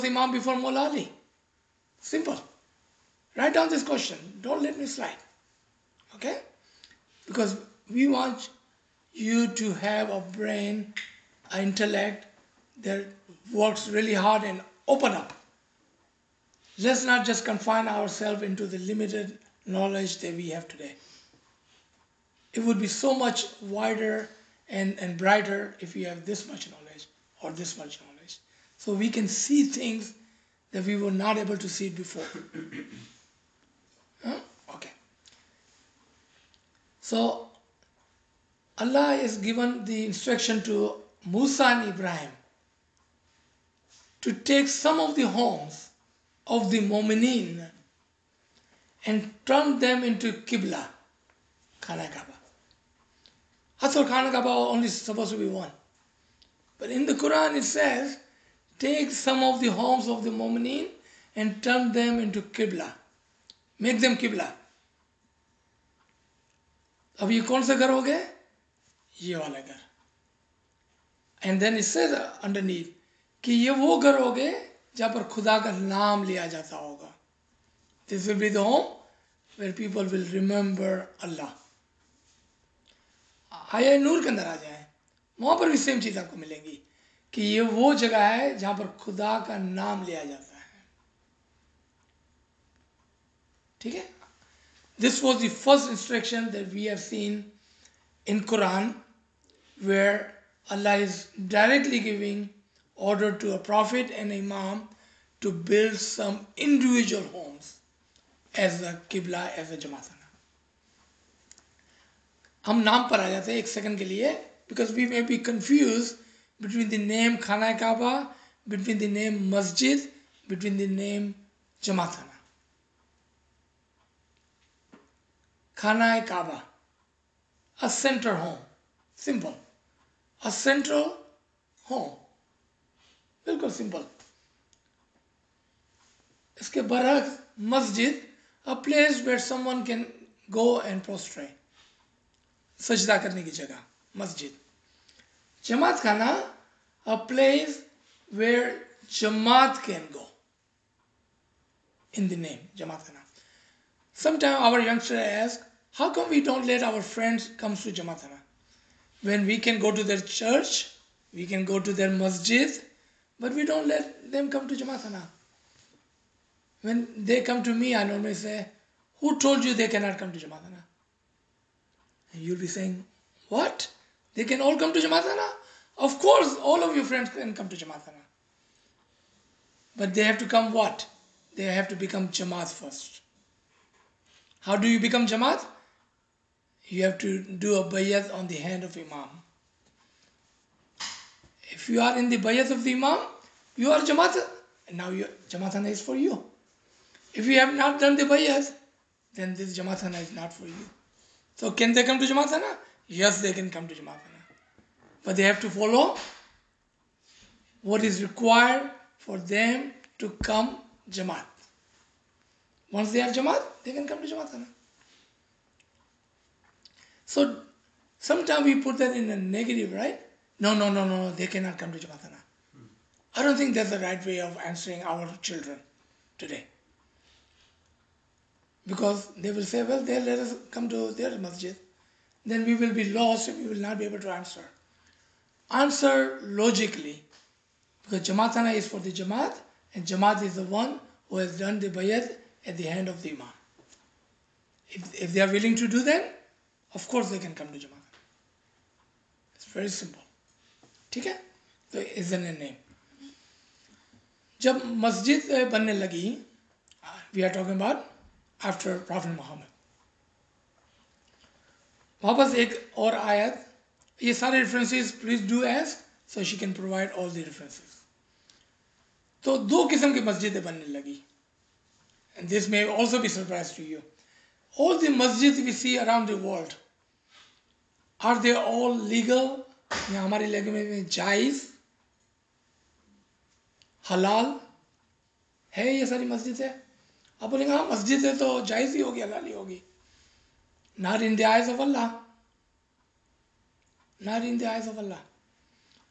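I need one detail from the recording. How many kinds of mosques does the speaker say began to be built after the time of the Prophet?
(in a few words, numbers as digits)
2.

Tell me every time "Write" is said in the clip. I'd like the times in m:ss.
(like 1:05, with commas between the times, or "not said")
0:03.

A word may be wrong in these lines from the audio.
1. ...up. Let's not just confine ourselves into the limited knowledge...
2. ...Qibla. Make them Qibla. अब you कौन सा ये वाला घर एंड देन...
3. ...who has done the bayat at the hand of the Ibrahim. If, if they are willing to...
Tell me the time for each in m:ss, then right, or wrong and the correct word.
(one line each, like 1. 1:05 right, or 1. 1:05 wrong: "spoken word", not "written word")
1. 0:15 right
2. 1:02 right
3. 4:01 wrong: "Imam", not "Ibrahim".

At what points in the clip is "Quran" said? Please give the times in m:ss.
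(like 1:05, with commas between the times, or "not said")
0:57.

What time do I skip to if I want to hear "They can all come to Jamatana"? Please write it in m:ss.
2:54.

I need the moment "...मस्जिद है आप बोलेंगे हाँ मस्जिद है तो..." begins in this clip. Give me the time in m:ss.
4:46.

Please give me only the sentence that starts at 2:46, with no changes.
When they come to me, I normally say, Who told you they cannot come to Jamatana?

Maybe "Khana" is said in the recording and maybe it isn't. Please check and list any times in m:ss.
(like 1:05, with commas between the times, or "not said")
0:51, 1:57, 2:05.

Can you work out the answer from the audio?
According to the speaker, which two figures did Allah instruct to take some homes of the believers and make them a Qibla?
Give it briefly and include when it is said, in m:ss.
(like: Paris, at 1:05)
Musa and Ibrahim, at 0:41.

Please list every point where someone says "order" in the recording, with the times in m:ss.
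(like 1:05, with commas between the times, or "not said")
1:42.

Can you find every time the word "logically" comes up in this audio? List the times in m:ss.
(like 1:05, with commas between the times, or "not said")
3:56.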